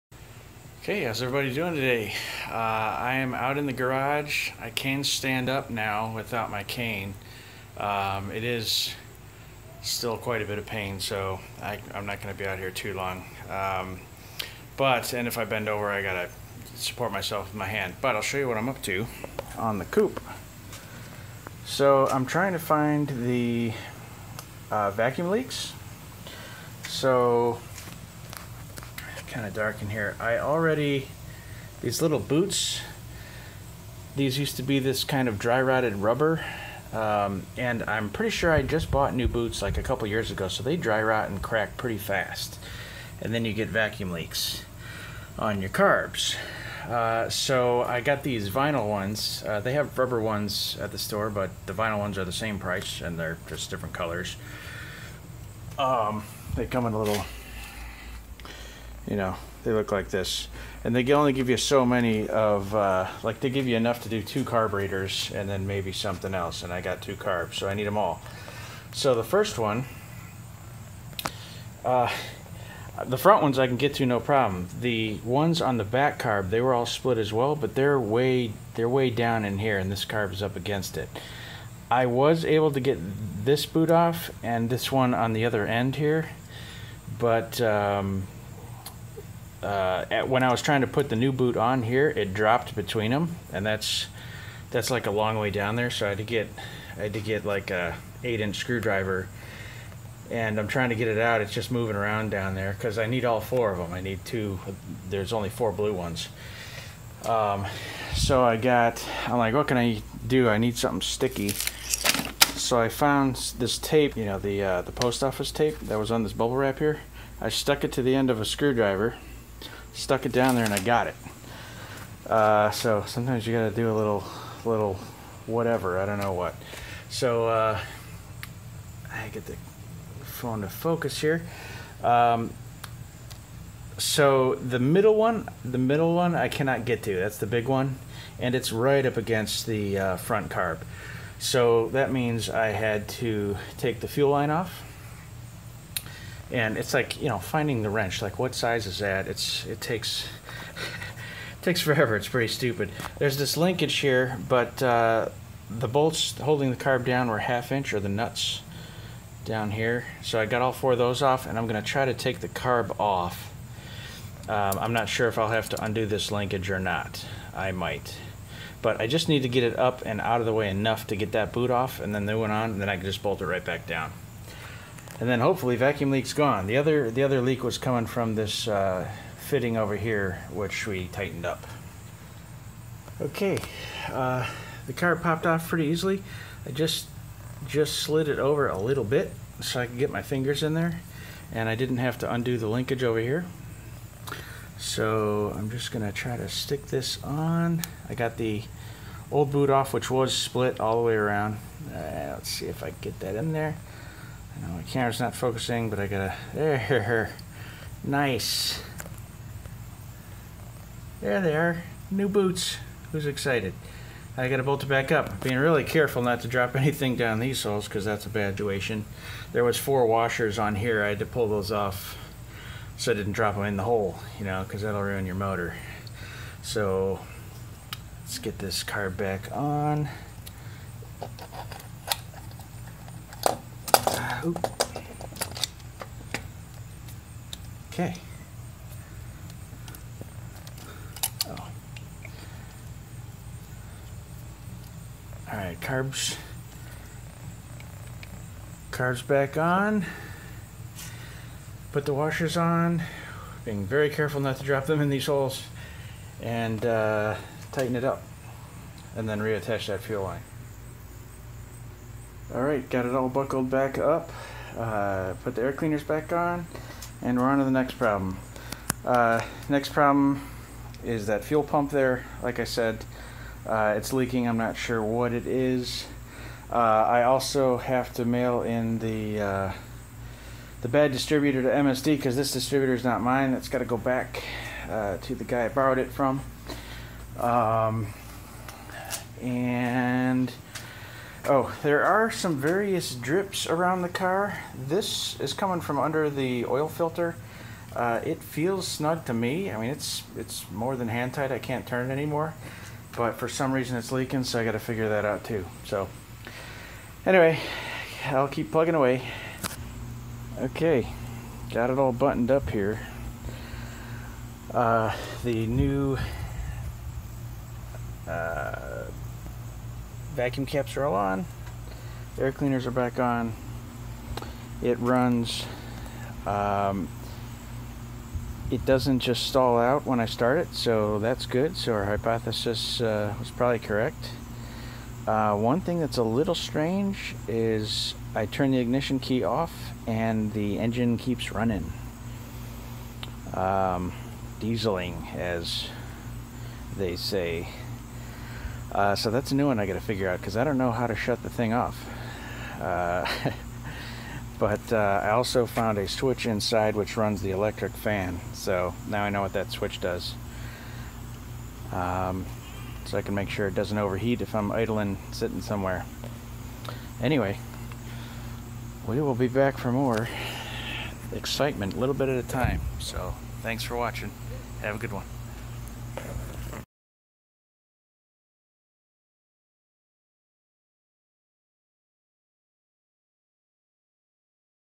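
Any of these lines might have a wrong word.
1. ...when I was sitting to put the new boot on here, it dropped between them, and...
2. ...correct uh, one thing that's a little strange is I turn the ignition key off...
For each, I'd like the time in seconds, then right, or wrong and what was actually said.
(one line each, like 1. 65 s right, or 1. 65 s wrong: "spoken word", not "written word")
1. 90 s wrong: "trying", not "sitting"
2. 333 s right.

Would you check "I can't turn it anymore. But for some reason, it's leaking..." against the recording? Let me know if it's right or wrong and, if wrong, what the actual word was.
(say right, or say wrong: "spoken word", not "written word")
right.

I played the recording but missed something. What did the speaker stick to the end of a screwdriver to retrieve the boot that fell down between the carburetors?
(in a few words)
post office tape.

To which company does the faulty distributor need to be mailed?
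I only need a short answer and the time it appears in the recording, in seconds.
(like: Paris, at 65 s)
MSD, at 281 s.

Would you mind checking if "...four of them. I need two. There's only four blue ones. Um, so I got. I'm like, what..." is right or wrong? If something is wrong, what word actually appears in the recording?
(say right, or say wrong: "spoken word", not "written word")
right.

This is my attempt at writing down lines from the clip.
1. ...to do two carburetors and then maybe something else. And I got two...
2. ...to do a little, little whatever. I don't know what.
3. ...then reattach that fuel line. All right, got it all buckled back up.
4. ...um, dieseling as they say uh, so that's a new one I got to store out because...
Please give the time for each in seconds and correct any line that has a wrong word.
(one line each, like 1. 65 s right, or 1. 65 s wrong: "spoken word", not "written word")
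1. 64 s right
2. 123 s right
3. 259 s right
4. 343 s wrong: "figure", not "store".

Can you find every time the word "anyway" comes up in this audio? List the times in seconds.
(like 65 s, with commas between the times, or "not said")
307 s, 367 s.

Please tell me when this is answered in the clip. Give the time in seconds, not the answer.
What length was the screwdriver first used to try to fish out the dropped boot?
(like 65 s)
98 s.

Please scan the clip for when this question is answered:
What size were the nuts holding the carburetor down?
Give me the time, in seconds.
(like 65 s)
157 s.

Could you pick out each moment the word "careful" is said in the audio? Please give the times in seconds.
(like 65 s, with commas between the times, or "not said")
215 s, 254 s.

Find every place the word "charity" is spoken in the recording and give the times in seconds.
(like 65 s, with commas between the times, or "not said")
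not said.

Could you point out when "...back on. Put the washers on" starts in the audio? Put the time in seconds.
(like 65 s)
249 s.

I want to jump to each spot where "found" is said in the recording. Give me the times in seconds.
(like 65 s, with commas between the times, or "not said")
112 s, 355 s.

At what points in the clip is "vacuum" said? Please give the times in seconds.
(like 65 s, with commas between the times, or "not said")
24 s, 43 s, 175 s, 320 s.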